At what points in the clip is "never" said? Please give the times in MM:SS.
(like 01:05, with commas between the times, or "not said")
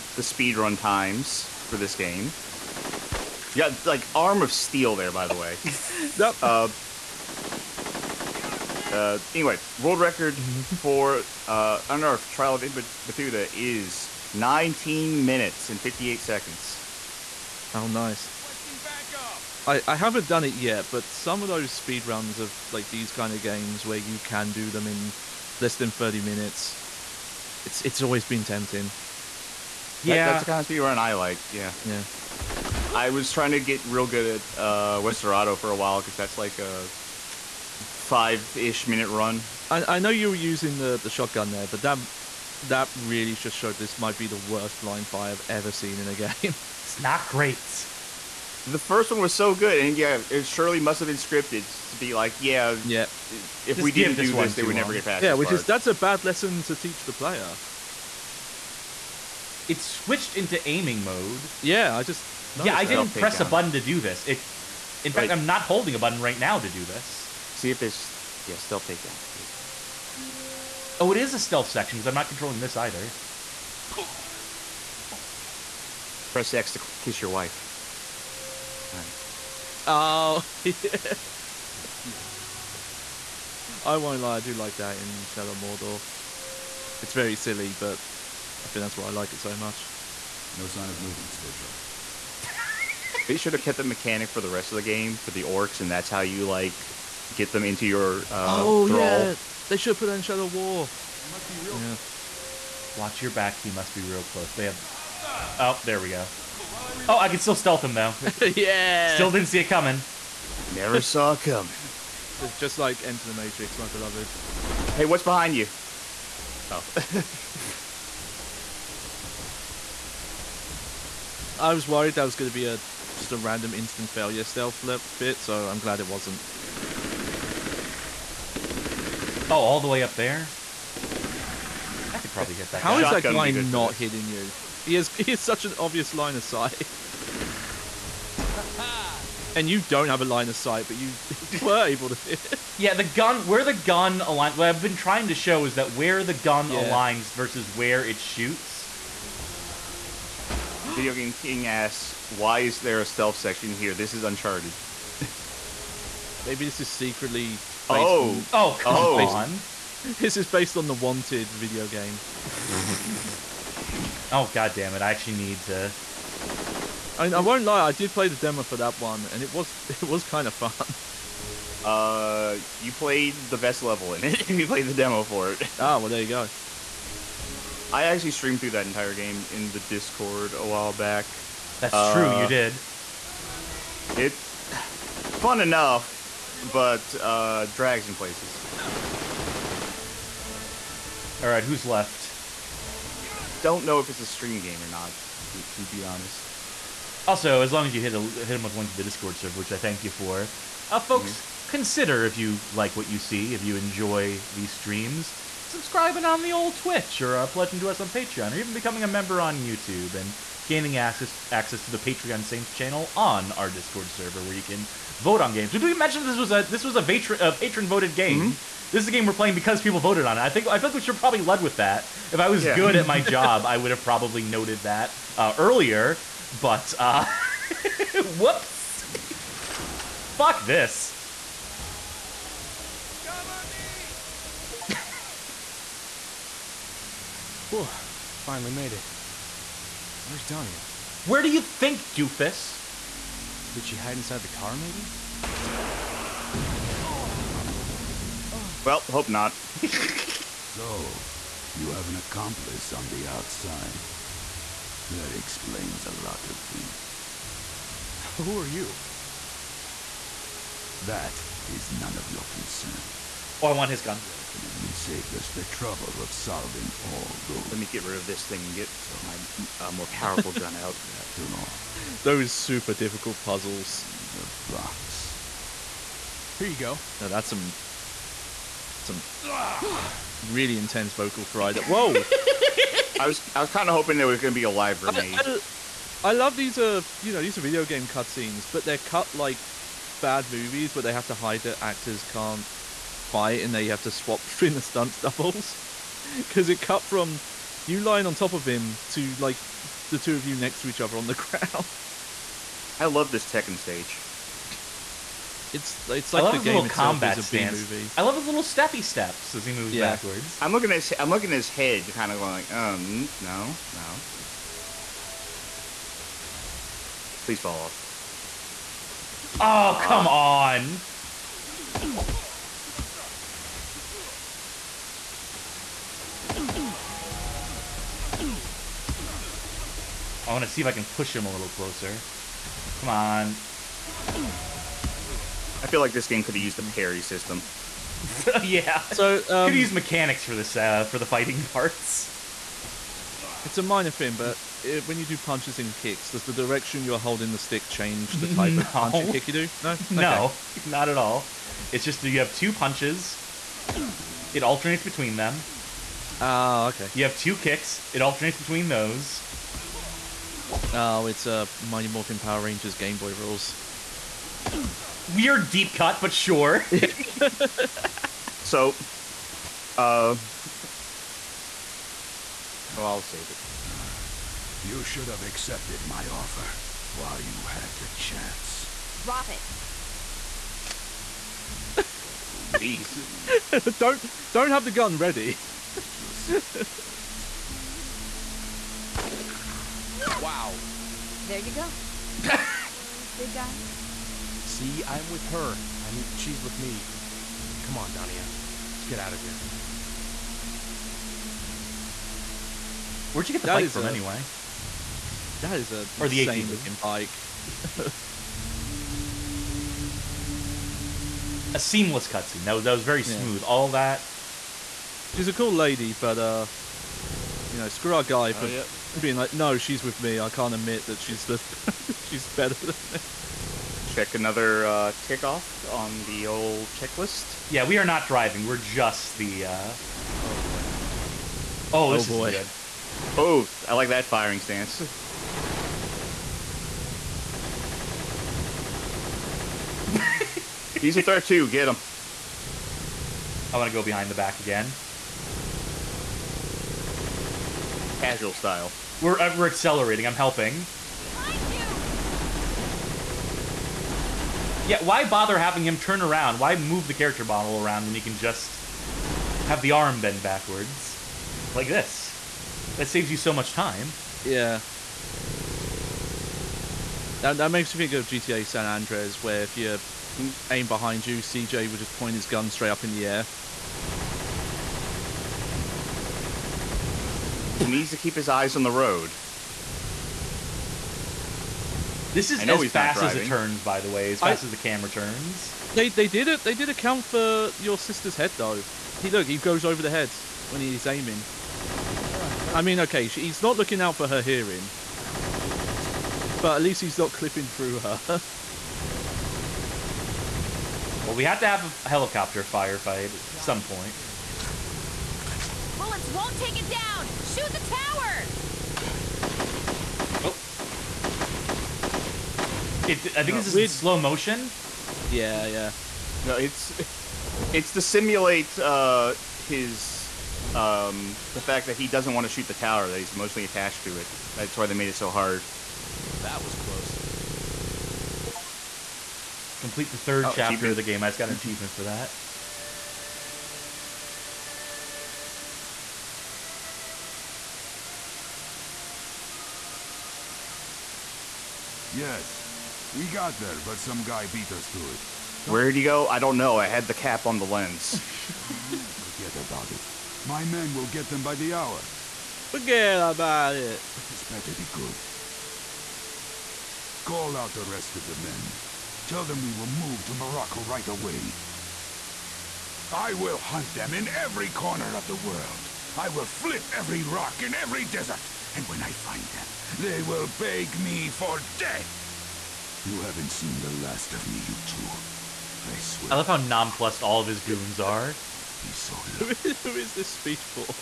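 00:54, 01:50.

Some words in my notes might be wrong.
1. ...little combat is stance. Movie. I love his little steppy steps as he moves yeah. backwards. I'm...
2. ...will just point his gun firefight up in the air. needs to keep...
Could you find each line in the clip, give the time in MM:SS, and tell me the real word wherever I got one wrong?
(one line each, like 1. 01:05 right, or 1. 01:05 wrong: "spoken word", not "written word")
1. 05:06 right
2. 07:51 wrong: "straight", not "firefight".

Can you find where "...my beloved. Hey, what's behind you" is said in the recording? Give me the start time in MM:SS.
01:53.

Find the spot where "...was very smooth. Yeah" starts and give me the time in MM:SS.
06:52.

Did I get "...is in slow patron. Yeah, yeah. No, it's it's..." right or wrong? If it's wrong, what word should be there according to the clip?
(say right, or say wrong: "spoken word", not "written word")
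wrong: "motion", not "patron".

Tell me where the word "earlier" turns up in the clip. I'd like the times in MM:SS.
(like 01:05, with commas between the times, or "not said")
03:45.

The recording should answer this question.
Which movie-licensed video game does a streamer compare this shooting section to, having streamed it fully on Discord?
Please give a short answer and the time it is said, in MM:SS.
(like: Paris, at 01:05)
Wanted, at 02:40.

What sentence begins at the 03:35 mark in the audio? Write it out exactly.
Did we mention this was a this was a patron, patron voted game?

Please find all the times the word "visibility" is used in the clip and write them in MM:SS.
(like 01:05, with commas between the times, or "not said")
not said.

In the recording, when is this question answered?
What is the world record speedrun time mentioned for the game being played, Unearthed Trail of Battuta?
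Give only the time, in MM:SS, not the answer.
00:14.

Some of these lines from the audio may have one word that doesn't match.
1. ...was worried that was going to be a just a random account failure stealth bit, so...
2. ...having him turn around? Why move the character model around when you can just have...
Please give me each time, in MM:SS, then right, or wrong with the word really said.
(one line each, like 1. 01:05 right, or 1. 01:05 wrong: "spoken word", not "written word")
1. 02:01 wrong: "instant", not "account"
2. 07:35 right.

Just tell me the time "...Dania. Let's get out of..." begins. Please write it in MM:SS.
06:38.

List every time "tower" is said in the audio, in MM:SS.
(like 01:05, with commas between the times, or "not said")
08:27, 08:42.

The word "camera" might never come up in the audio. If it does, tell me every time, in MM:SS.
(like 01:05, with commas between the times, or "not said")
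08:04.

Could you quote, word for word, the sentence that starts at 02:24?
What I've been trying to show is that where the gun yeah.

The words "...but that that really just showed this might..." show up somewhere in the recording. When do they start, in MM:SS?
00:41.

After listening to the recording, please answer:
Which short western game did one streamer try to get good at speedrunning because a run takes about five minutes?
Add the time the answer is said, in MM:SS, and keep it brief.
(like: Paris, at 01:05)
Westerado, at 00:35.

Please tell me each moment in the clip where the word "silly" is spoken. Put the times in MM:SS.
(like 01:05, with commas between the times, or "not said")
01:27.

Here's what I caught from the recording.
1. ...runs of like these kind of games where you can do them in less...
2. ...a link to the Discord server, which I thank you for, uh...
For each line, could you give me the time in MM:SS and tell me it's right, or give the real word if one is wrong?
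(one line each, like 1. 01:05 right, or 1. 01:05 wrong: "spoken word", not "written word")
1. 00:22 right
2. 03:18 right.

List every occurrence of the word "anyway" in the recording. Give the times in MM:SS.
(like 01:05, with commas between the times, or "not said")
00:09, 06:44.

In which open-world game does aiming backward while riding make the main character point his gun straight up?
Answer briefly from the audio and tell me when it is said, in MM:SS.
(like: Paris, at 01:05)
GTA San Andreas, at 07:48.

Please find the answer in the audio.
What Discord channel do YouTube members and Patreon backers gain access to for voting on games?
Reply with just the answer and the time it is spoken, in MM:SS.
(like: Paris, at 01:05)
Patreon Saints, at 03:31.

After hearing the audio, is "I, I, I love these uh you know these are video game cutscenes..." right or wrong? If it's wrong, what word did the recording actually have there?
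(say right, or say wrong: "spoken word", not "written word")
right.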